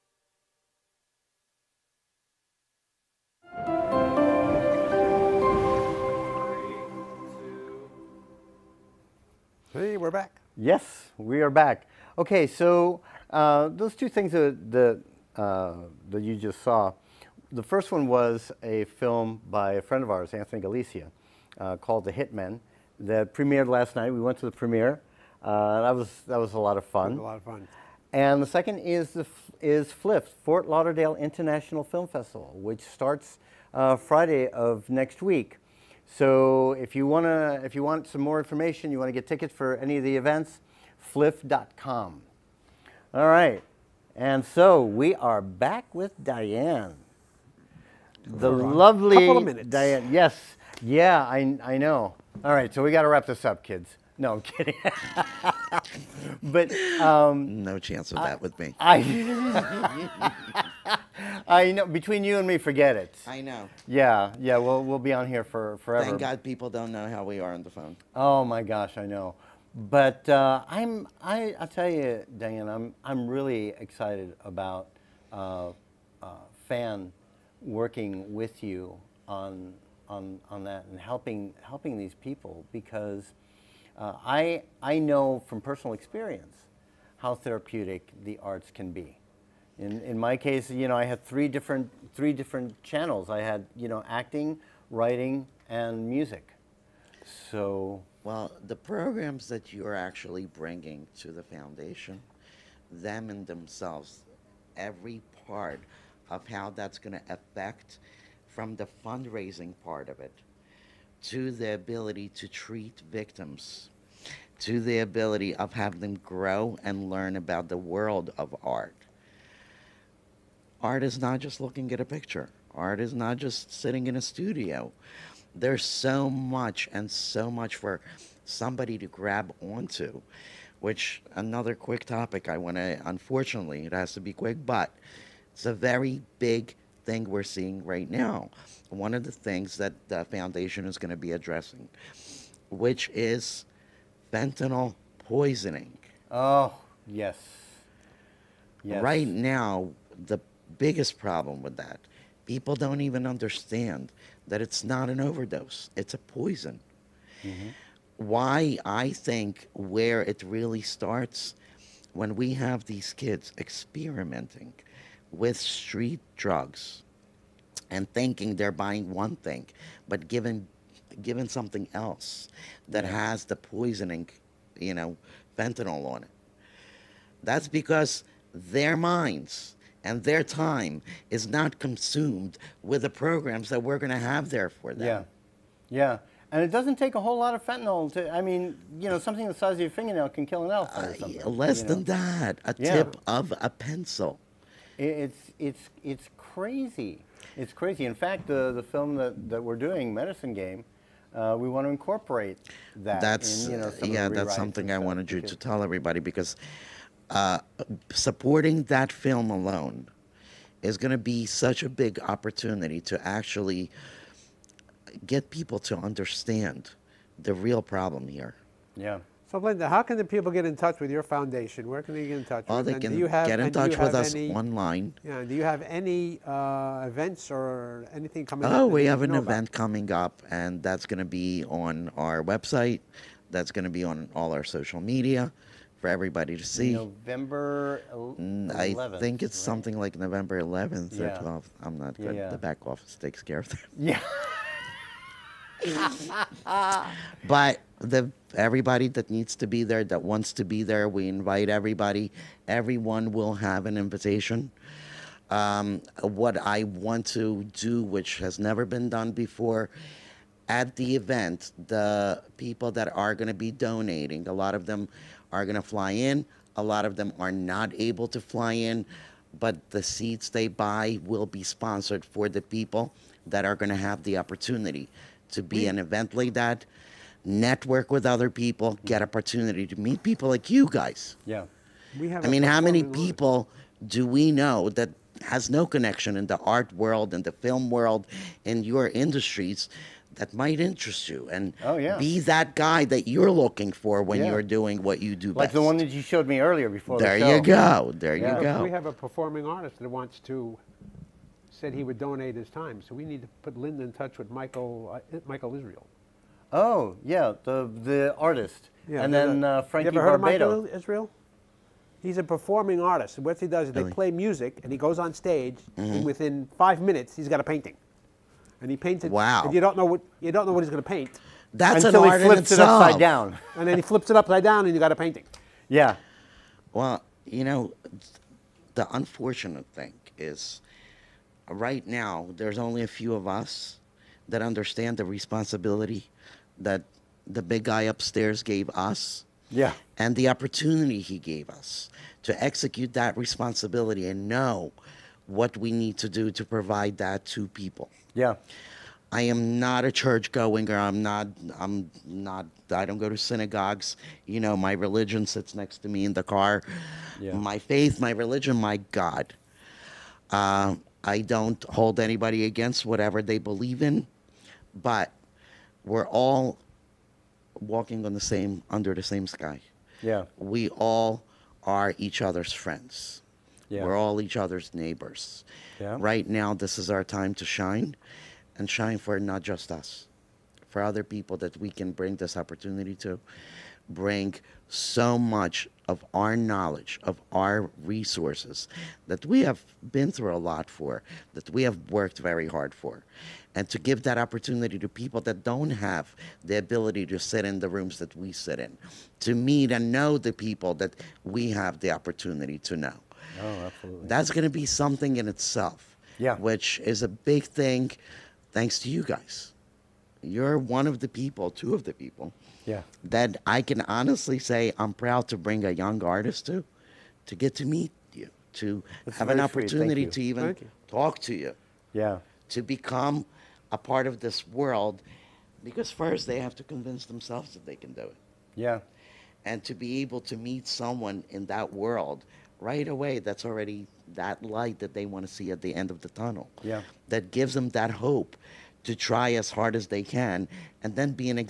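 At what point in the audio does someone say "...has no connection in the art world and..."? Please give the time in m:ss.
4:45.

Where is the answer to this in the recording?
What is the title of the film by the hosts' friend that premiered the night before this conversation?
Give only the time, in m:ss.
0:22.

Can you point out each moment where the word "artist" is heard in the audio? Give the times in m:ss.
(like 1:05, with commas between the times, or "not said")
4:59, 5:08, 5:12, 6:56.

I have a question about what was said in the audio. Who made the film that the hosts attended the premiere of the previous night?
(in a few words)
Anthony Galicia.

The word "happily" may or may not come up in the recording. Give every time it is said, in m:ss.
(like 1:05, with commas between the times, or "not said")
not said.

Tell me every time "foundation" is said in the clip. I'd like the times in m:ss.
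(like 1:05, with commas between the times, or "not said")
1:41, 2:20, 3:41.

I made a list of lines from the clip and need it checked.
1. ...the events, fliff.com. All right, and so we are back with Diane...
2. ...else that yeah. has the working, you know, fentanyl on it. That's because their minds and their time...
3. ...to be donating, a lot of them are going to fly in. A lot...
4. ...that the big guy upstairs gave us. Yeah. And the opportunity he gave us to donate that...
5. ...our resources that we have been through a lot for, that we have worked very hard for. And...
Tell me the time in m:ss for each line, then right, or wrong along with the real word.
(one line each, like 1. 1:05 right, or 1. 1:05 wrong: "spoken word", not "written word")
1. 0:40 right
2. 2:51 wrong: "poisoning", not "working"
3. 4:23 right
4. 5:36 wrong: "execute", not "donate"
5. 6:27 right.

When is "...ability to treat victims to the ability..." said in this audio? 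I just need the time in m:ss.
1:51.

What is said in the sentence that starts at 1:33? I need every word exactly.
I had, you know, acting, writing, and music.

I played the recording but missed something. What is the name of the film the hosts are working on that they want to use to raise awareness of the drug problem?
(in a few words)
Medicine Game.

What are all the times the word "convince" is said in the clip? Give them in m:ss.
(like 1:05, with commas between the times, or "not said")
7:06.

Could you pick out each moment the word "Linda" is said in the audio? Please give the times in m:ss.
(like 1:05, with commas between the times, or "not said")
3:39, 5:03.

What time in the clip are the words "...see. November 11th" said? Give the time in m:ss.
3:56.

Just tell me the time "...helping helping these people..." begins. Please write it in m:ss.
1:20.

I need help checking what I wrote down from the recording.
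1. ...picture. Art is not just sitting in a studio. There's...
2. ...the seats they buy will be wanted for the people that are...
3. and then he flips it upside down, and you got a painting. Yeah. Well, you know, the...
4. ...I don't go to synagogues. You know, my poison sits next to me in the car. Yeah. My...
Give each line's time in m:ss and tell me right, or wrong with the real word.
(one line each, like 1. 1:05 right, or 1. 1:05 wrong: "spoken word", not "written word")
1. 2:02 right
2. 4:29 wrong: "sponsored", not "wanted"
3. 5:23 right
4. 5:52 wrong: "religion", not "poison".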